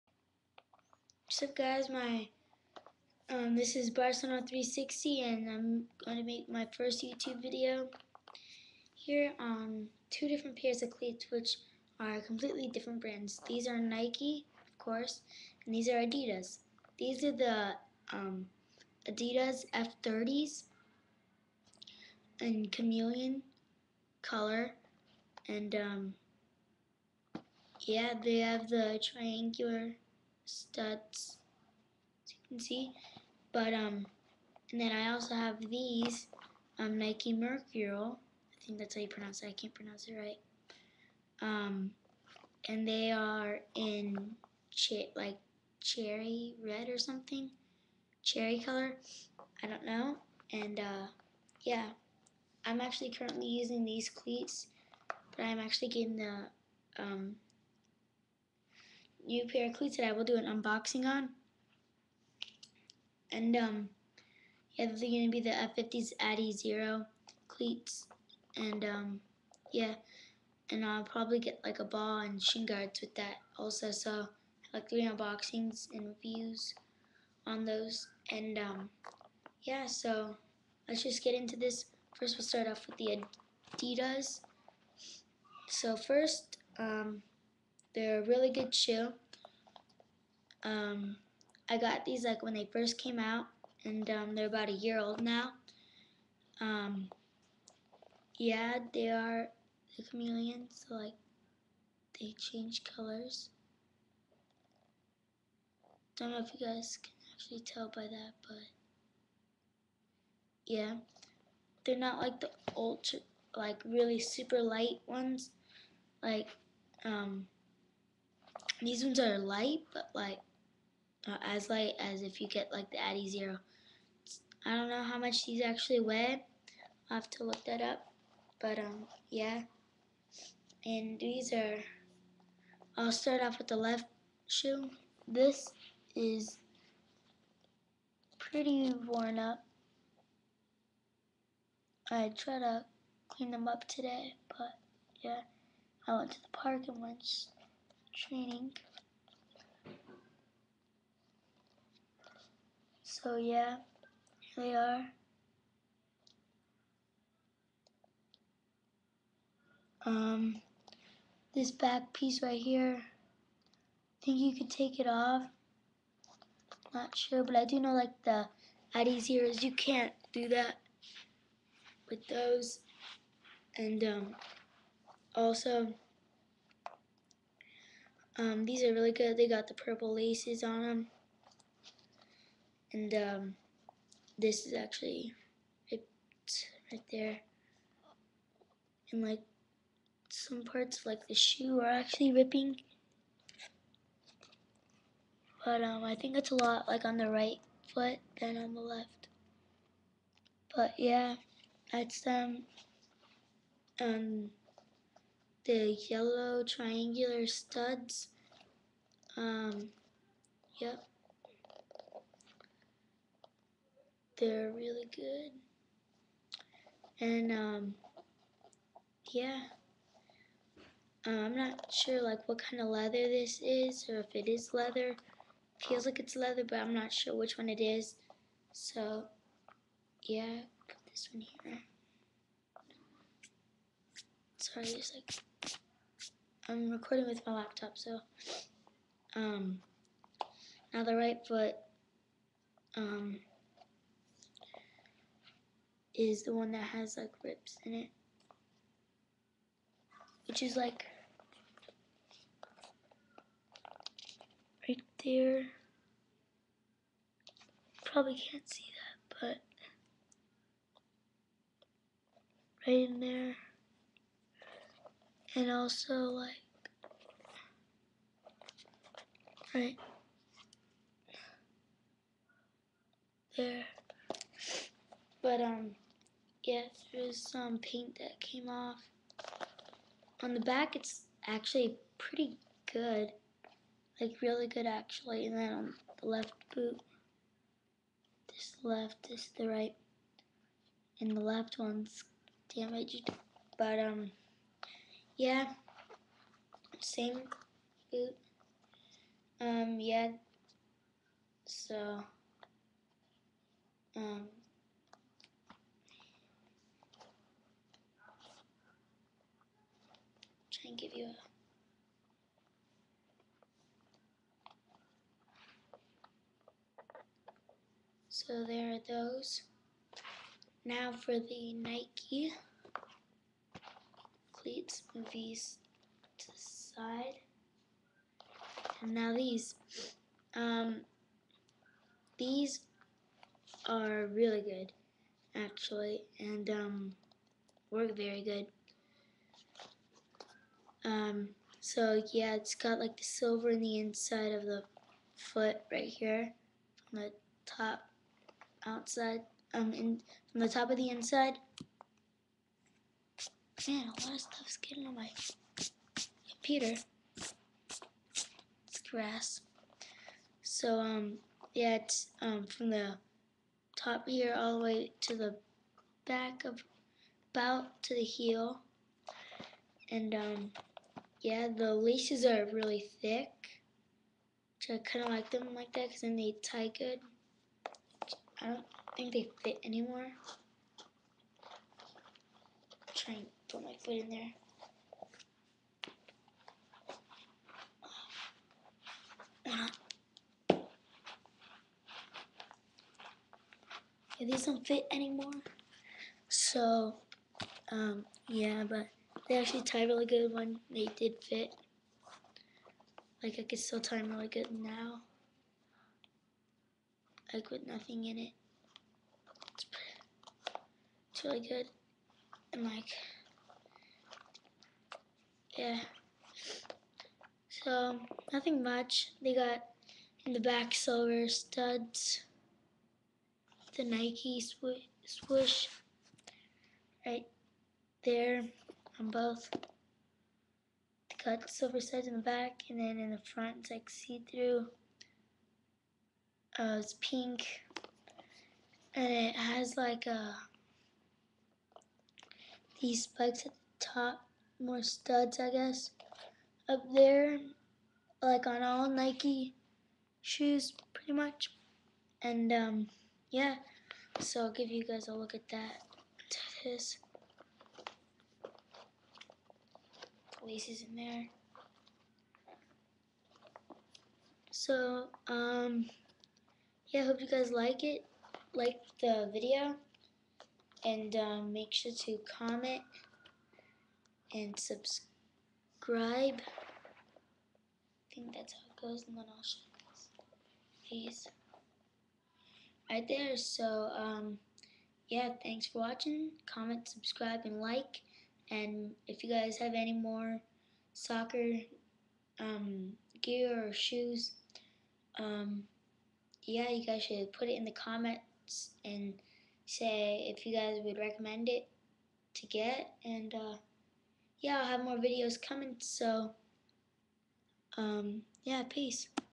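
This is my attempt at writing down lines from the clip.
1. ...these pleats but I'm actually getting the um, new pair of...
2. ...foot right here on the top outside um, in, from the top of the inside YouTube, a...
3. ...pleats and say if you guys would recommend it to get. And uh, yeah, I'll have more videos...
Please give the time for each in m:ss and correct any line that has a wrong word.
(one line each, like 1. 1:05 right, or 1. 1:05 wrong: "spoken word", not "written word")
1. 0:53 wrong: "cleats", not "pleats"
2. 5:45 wrong: "Man", not "YouTube"
3. 8:17 wrong: "comments", not "pleats".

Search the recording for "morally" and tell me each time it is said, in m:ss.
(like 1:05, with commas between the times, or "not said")
not said.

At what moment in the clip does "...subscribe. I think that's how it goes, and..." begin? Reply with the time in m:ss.
7:54.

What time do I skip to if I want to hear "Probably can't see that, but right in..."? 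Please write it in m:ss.
4:18.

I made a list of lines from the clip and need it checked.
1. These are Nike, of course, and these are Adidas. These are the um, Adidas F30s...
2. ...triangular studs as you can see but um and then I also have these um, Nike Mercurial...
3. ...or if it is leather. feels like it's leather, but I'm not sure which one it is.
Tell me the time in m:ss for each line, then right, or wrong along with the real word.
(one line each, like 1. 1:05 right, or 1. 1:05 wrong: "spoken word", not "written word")
1. 0:13 right
2. 0:29 right
3. 3:44 right.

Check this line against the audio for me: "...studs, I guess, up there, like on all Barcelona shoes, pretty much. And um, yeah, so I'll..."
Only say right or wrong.
wrong.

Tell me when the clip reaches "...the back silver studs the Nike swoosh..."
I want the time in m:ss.
7:00.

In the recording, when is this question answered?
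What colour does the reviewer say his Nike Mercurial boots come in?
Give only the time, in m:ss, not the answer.
0:45.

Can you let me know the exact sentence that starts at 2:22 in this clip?
I try to clean them up today, but yeah, I went to the park and went training.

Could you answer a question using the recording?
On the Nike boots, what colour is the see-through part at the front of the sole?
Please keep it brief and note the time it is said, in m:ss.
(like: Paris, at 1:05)
pink, at 7:16.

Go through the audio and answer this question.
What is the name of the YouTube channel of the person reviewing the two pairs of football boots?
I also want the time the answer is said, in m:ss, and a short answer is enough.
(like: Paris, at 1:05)
Barcelona 360, at 0:03.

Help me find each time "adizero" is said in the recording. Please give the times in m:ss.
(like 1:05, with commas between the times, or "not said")
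1:06, 2:02.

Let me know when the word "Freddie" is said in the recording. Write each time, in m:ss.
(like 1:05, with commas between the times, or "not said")
not said.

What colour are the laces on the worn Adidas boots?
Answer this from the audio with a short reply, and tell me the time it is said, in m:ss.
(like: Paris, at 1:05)
purple, at 2:59.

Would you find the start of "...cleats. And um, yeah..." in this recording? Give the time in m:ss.
1:07.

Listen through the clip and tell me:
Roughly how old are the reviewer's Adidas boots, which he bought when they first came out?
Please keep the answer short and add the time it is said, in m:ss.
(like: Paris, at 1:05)
1 year, at 1:34.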